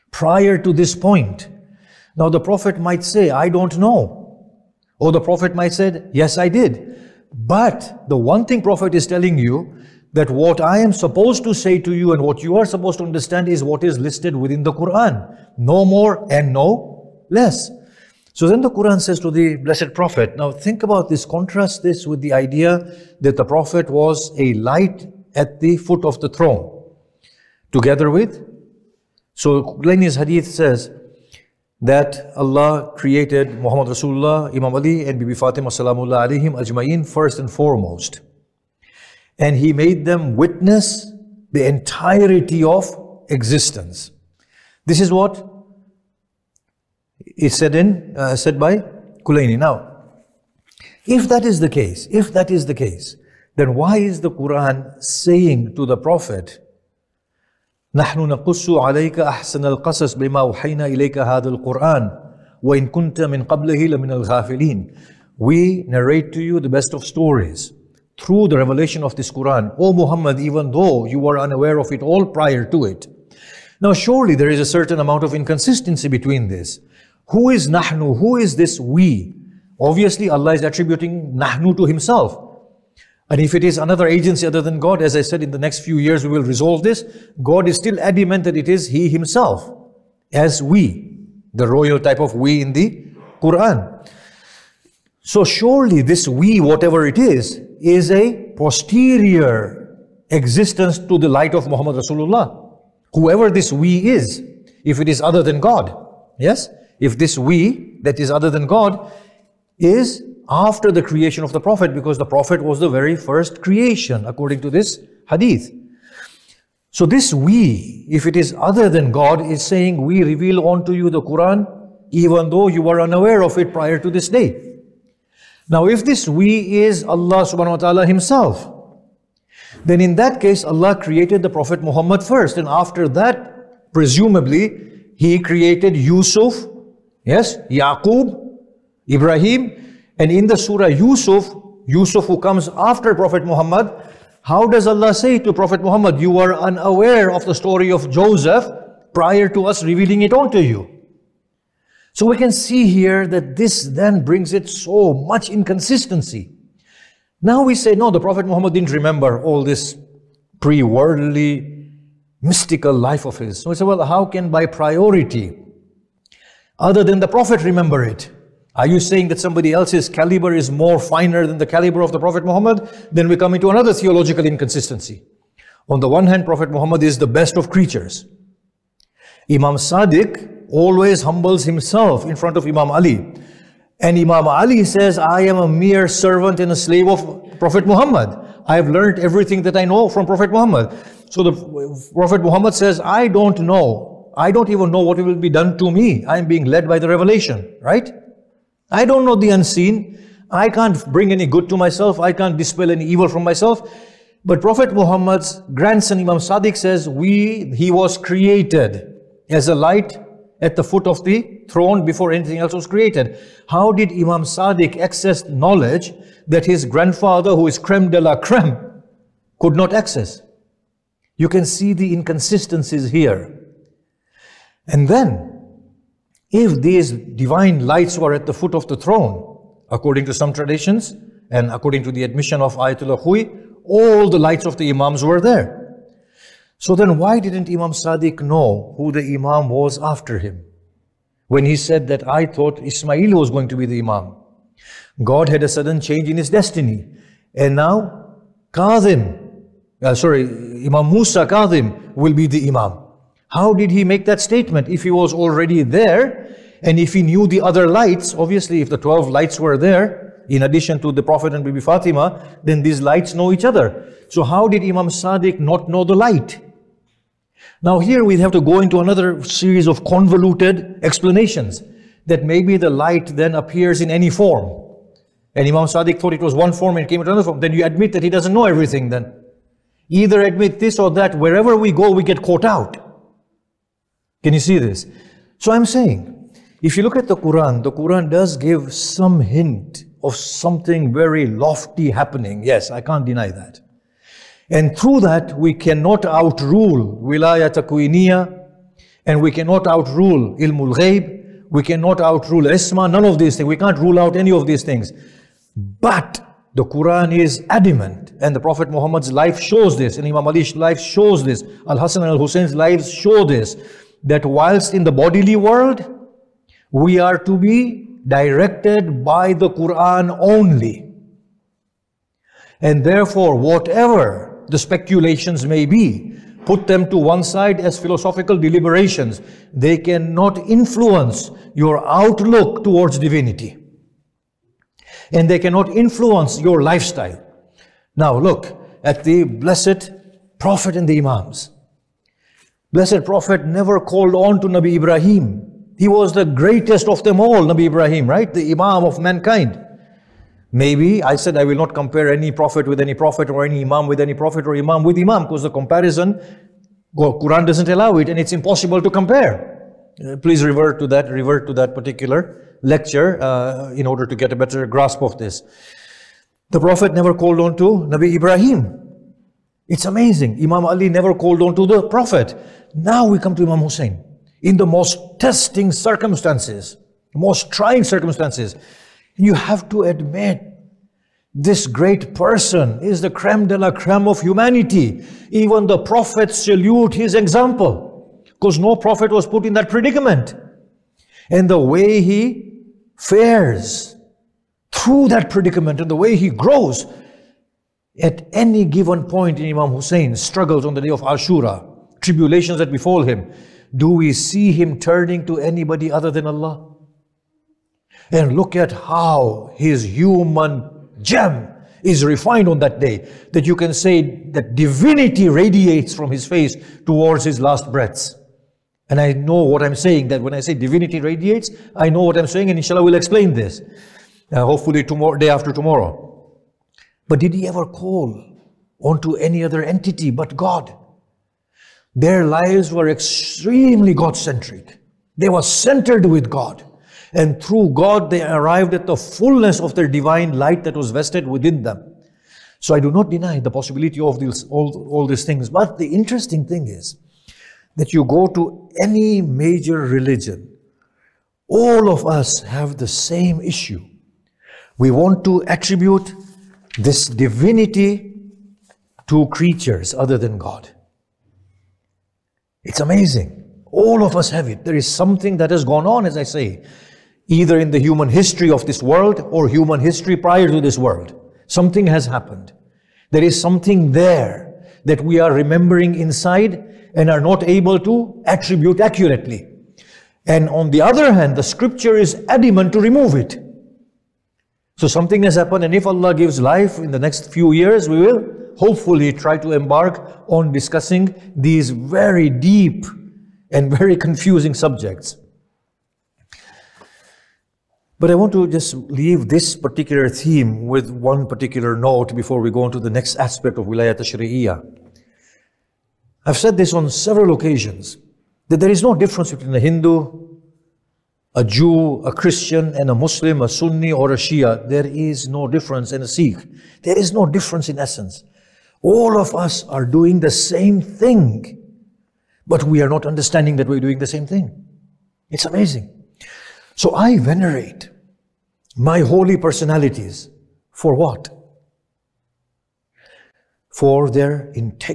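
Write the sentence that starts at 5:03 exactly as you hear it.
We can't rule out any of these things.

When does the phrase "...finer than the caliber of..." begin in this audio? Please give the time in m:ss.
2:50.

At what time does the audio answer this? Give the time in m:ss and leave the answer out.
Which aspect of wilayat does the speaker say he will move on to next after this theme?
8:23.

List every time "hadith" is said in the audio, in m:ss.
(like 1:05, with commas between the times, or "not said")
0:30, 1:55.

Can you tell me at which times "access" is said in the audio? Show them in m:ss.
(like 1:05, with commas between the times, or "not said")
3:34, 3:39.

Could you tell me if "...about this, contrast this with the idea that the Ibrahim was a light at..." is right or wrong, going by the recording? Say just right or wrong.
wrong.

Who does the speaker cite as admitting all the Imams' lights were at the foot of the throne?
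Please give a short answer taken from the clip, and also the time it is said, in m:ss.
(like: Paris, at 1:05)
Ayatollah Hui, at 3:52.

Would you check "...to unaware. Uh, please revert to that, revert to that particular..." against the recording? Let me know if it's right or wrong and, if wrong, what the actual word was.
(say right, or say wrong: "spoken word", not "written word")
wrong: "compare", not "unaware".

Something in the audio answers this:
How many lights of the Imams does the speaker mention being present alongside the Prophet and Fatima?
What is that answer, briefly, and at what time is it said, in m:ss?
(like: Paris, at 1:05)
12, at 4:18.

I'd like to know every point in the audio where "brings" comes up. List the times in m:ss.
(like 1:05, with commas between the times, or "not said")
2:34, 3:21.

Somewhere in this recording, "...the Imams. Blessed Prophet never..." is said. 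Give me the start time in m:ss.
5:41.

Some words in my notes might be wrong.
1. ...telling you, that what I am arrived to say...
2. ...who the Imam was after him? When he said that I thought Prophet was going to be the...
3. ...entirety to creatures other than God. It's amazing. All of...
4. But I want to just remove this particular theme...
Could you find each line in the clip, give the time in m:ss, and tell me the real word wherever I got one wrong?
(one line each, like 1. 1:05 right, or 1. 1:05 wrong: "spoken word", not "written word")
1. 0:09 wrong: "supposed", not "arrived"
2. 3:58 wrong: "Ismail", not "Prophet"
3. 7:37 wrong: "divinity", not "entirety"
4. 8:18 wrong: "leave", not "remove".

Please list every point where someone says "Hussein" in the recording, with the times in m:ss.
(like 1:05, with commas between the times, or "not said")
5:12, 6:13, 6:39.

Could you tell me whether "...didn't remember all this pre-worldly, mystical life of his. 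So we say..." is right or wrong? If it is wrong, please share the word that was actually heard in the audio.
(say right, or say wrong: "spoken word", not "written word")
right.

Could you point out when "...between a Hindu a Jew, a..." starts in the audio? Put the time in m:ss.
8:29.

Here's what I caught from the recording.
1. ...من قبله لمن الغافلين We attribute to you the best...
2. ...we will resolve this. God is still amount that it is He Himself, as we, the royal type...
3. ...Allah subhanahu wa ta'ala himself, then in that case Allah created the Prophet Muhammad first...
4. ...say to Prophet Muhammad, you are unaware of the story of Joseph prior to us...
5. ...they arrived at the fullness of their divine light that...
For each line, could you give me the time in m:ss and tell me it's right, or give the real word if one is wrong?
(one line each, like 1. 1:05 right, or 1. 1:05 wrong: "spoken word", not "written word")
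1. 1:03 wrong: "narrate", not "attribute"
2. 1:26 wrong: "adamant", not "amount"
3. 2:07 right
4. 2:25 right
5. 7:18 right.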